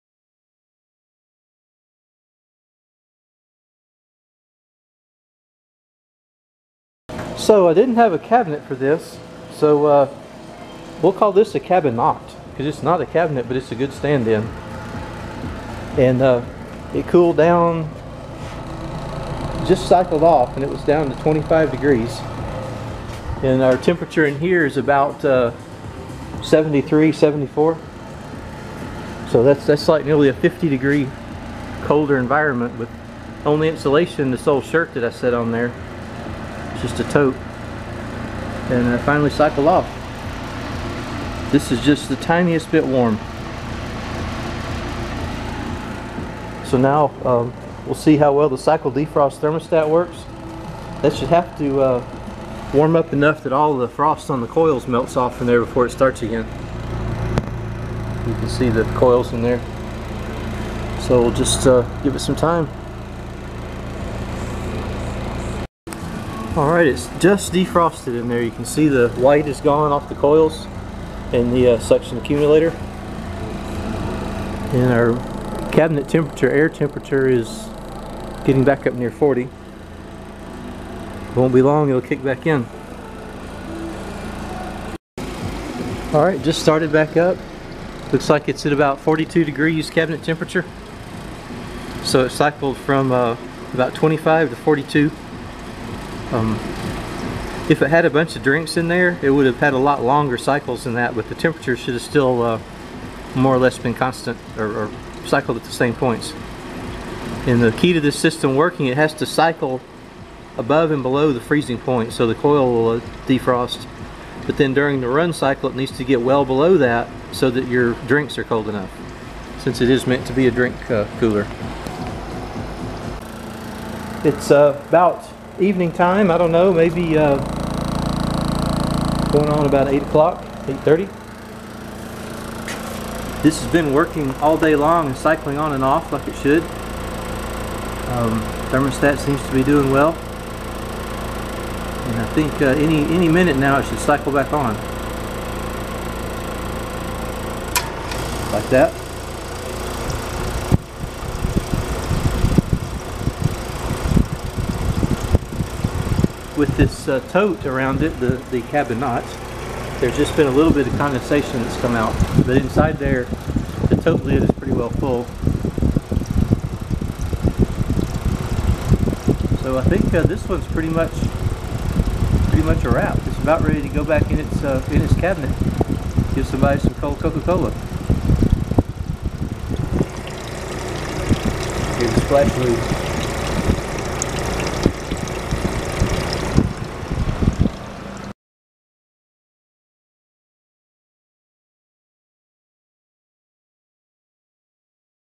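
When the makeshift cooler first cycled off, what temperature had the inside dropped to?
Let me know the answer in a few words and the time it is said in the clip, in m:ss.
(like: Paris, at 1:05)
25 degrees, at 0:21.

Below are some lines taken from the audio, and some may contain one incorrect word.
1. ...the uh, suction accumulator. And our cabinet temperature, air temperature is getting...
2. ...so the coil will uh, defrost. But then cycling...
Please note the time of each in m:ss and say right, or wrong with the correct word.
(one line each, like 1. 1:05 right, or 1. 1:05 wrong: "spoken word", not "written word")
1. 1:11 right
2. 1:52 wrong: "during", not "cycling".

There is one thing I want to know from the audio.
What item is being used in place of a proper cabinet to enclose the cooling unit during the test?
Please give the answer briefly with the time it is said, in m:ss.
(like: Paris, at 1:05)
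A tote, at 0:36.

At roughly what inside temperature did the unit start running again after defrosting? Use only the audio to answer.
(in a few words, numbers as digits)
42 degrees.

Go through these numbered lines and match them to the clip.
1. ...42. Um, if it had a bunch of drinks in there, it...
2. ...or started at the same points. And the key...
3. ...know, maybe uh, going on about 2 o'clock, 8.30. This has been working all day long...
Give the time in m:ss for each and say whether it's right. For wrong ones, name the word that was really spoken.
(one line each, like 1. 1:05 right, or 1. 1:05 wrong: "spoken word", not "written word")
1. 1:34 right
2. 1:44 wrong: "cycled", not "started"
3. 2:06 wrong: "8", not "2".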